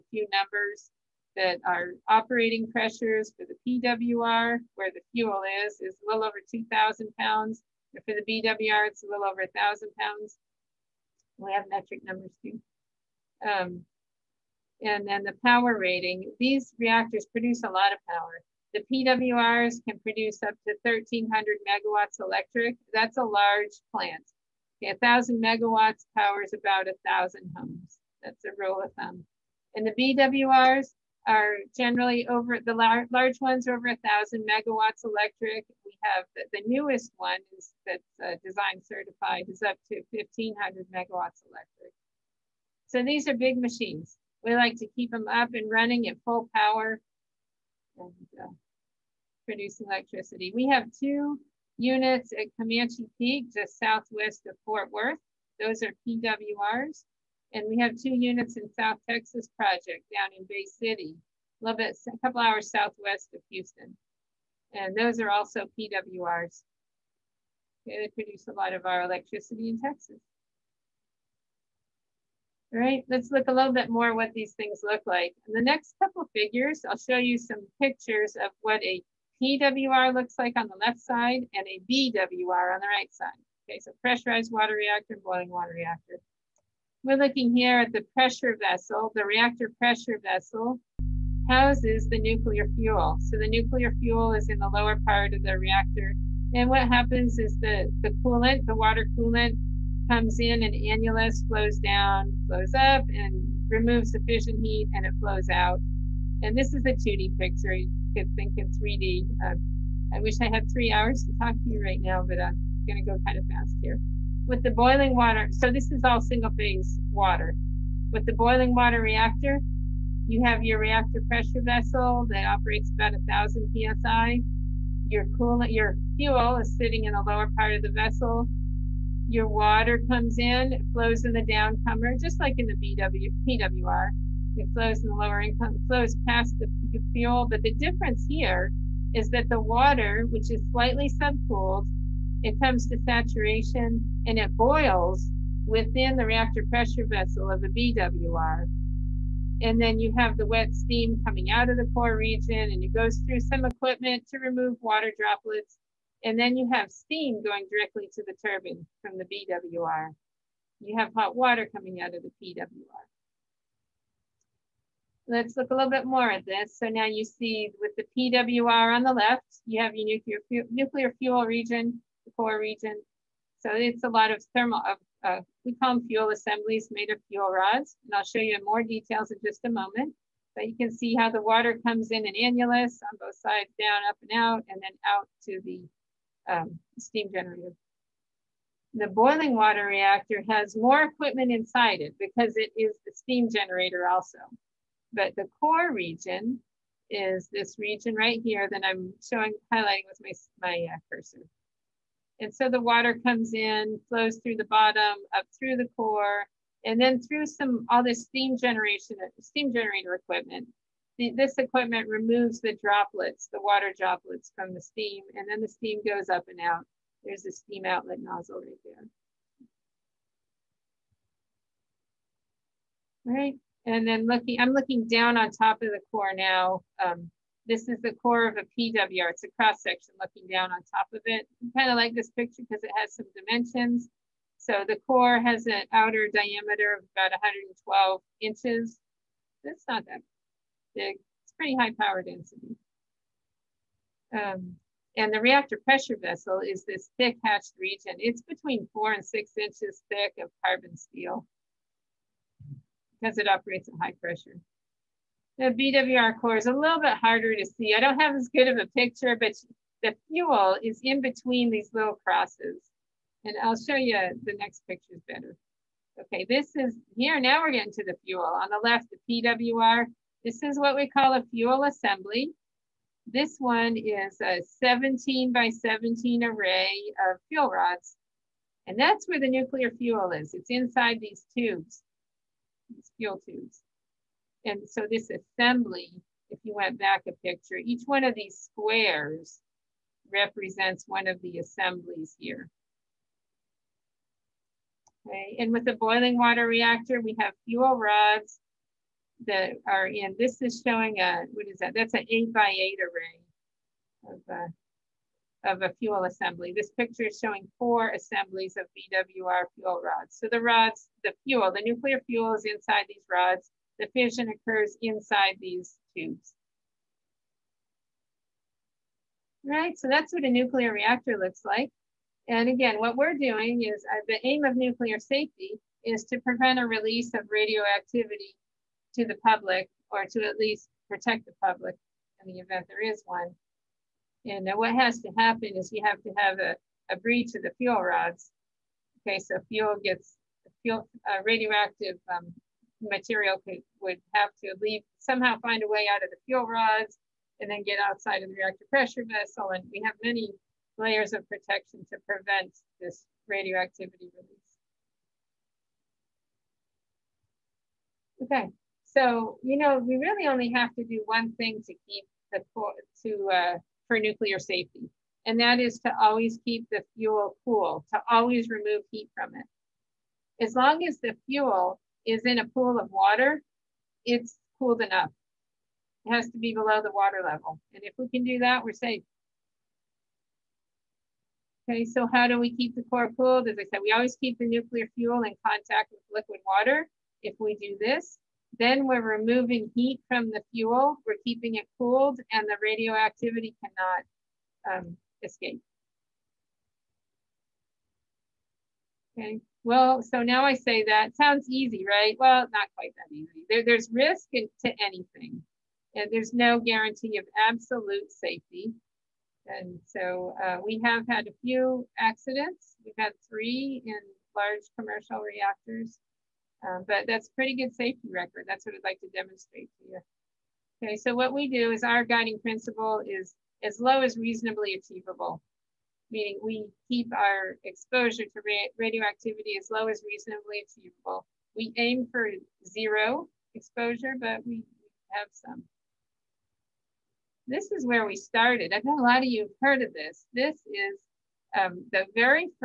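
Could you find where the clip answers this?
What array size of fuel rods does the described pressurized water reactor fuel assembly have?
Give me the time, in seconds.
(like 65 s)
274 s.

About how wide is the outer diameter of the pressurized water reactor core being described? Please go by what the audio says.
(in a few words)
112 inches.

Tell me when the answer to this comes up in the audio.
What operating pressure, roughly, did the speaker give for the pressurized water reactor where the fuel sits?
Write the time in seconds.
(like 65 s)
5 s.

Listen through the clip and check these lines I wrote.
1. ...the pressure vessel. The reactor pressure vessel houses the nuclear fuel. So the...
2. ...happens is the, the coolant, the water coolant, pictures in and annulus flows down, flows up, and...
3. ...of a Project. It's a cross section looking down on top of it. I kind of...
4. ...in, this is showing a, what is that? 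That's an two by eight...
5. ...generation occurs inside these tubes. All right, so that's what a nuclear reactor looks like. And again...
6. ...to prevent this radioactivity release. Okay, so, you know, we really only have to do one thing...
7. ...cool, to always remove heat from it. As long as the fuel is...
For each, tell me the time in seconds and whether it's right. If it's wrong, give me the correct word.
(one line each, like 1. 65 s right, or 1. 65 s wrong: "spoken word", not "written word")
1. 87 s right
2. 96 s wrong: "comes", not "pictures"
3. 228 s wrong: "PWR", not "Project"
4. 300 s wrong: "eight", not "two"
5. 314 s wrong: "fission", not "generation"
6. 352 s right
7. 367 s right.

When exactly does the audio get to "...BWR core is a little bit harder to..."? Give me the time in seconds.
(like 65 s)
255 s.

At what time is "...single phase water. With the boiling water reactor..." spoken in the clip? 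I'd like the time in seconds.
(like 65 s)
116 s.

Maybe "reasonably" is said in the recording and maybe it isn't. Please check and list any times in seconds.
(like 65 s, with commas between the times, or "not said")
424 s, 430 s.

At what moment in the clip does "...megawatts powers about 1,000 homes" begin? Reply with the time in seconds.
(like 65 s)
25 s.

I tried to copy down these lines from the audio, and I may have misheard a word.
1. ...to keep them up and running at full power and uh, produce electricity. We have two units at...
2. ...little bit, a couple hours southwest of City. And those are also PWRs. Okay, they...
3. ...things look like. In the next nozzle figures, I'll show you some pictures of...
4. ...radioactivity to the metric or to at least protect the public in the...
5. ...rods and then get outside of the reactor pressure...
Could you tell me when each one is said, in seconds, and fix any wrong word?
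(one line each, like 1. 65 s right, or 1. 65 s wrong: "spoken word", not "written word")
1. 44 s right
2. 61 s wrong: "Houston", not "City"
3. 74 s wrong: "couple", not "nozzle"
4. 327 s wrong: "public", not "metric"
5. 346 s right.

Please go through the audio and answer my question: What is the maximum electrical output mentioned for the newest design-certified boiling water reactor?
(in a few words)
1500 megawatts electric.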